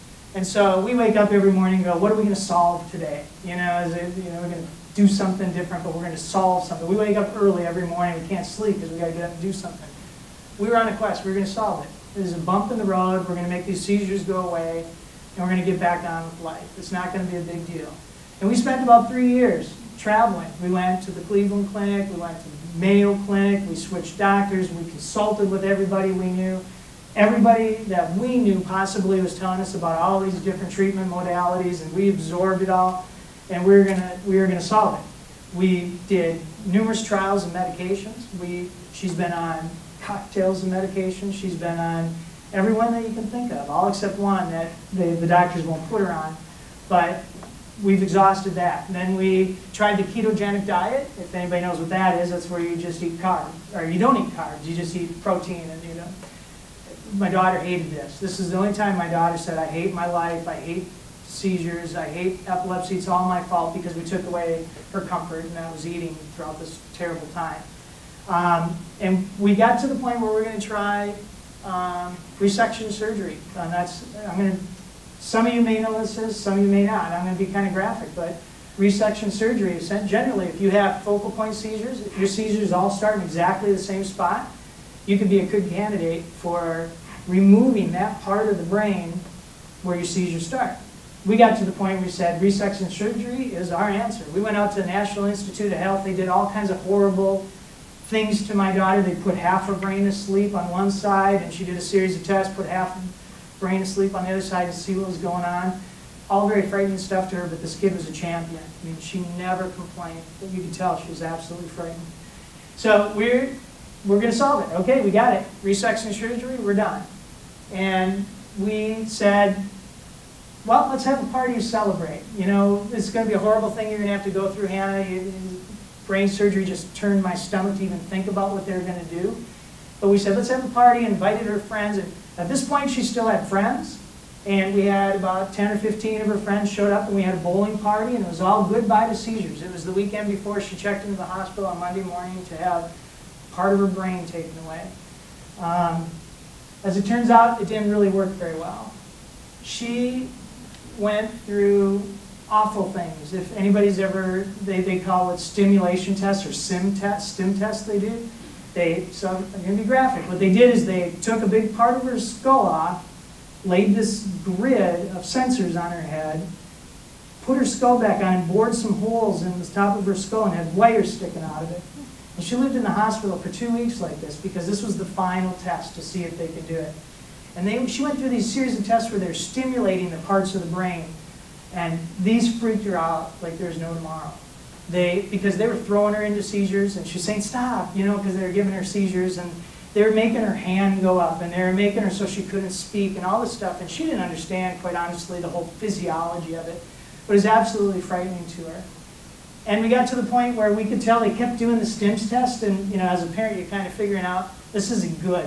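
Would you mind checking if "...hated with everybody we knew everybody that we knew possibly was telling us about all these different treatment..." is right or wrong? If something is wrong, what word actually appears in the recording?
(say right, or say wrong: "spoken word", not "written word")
wrong: "consulted", not "hated".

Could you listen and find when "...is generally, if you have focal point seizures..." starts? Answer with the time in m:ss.
1:19.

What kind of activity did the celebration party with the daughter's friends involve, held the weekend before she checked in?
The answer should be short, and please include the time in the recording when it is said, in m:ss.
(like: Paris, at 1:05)
Bowling, at 2:17.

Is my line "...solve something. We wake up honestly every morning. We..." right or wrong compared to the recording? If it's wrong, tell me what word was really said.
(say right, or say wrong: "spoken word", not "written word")
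wrong: "early", not "honestly".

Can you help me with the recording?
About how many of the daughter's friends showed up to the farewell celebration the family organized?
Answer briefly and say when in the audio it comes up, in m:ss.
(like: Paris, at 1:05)
10 or 15, at 2:15.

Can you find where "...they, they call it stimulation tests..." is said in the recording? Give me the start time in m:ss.
2:34.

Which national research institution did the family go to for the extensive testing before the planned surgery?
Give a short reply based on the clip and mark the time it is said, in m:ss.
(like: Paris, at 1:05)
National Institute of Health, at 1:34.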